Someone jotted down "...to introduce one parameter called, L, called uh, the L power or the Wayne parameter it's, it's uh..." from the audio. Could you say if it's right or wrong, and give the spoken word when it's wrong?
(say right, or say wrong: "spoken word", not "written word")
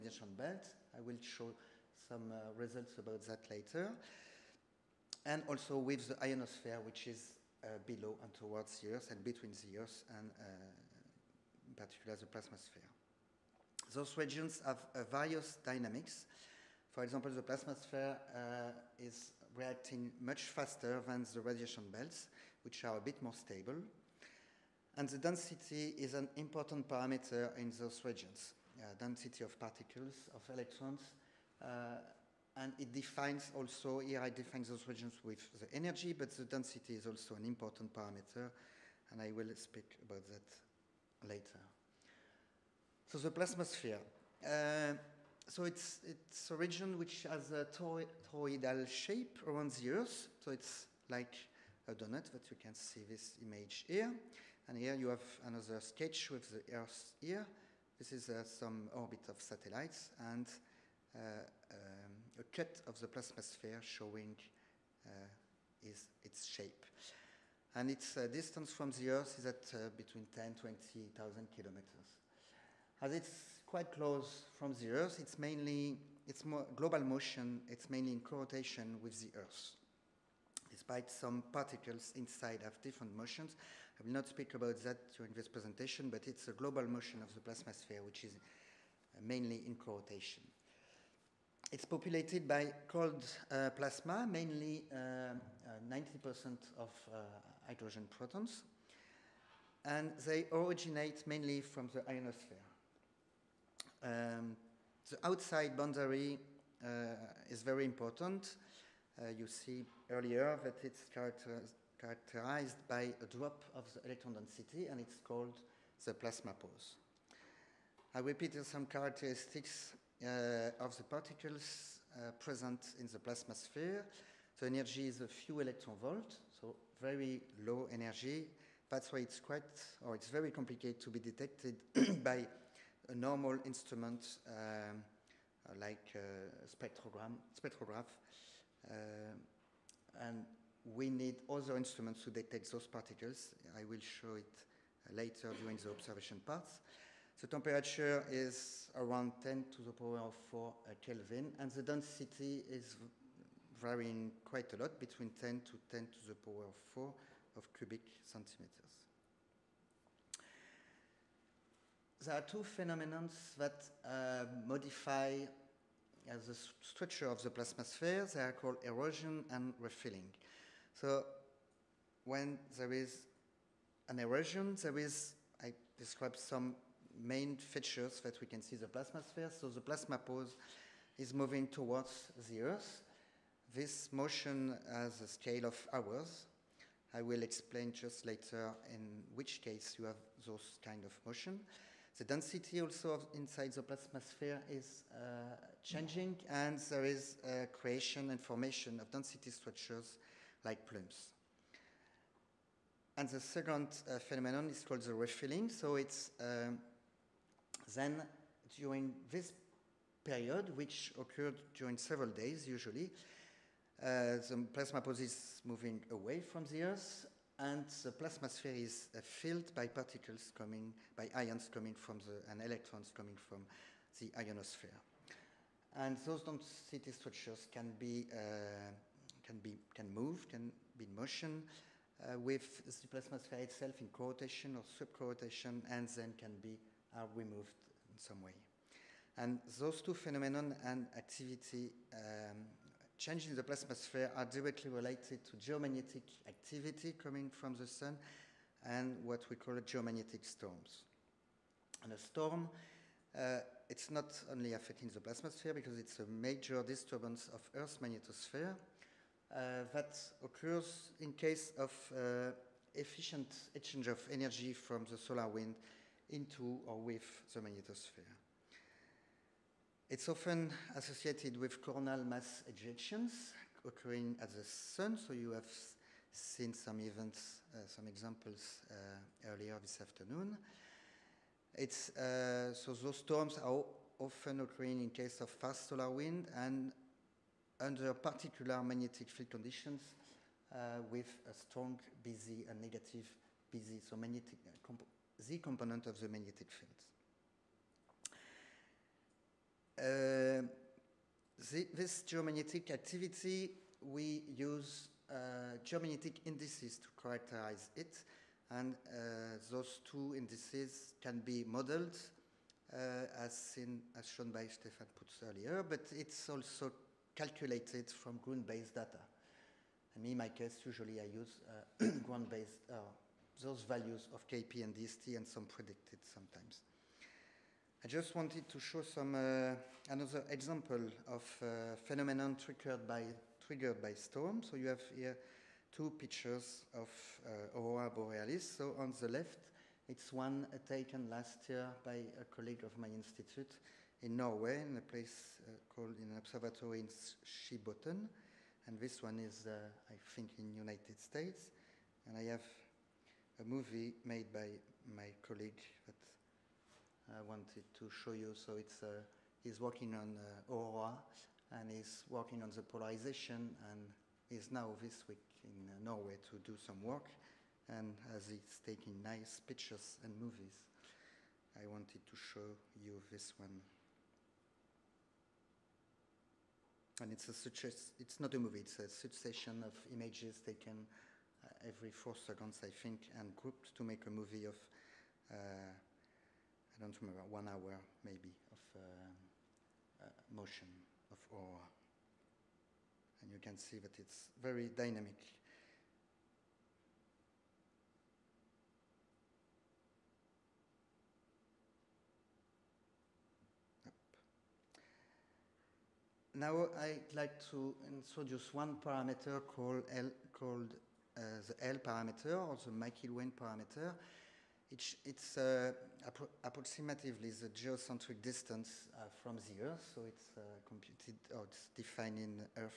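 wrong: "parameter", not "power".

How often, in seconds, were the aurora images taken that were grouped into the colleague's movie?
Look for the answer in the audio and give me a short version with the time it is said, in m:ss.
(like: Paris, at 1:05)
4 seconds, at 6:21.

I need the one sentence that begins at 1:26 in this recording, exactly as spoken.
But it's a global motion of the plasma sphere, which is uh, mainly in co-rotation.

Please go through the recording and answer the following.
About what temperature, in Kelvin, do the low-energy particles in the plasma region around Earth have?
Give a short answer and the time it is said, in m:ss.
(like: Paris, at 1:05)
10^4 Kelvin, at 2:29.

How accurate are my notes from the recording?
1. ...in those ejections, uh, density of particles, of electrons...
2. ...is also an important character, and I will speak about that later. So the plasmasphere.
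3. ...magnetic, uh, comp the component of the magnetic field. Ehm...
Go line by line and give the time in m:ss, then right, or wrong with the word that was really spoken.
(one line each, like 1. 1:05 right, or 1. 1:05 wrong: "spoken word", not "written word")
1. 0:27 wrong: "regions", not "ejections"
2. 0:36 wrong: "parameter", not "character"
3. 4:54 right.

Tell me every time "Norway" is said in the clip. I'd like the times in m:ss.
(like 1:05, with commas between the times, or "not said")
5:44, 6:06.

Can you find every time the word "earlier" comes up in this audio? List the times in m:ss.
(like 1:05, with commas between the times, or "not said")
1:50, 4:39, 5:15.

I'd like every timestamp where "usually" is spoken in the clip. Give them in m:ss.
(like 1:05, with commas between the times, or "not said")
3:32, 5:20.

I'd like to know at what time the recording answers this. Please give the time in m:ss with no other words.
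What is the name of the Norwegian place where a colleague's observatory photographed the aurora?
5:47.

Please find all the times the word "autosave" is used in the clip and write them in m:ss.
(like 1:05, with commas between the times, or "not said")
not said.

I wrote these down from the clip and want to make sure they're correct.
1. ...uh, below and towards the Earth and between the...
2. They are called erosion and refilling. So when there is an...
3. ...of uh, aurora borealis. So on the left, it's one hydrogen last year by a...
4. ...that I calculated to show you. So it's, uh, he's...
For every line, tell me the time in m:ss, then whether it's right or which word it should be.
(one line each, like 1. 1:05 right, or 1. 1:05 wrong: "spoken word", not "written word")
1. 0:07 right
2. 2:48 right
3. 5:36 wrong: "taken", not "hydrogen"
4. 5:56 wrong: "wanted", not "calculated".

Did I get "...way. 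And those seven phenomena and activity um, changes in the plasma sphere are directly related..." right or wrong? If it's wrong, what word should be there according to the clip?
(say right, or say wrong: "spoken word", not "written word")
wrong: "two", not "seven".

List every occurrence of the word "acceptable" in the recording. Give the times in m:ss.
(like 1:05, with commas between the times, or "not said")
not said.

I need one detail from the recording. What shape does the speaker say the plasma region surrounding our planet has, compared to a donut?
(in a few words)
Toroidal.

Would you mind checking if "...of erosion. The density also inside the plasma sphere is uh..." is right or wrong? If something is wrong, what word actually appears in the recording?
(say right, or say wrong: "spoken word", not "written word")
wrong: "motion", not "erosion".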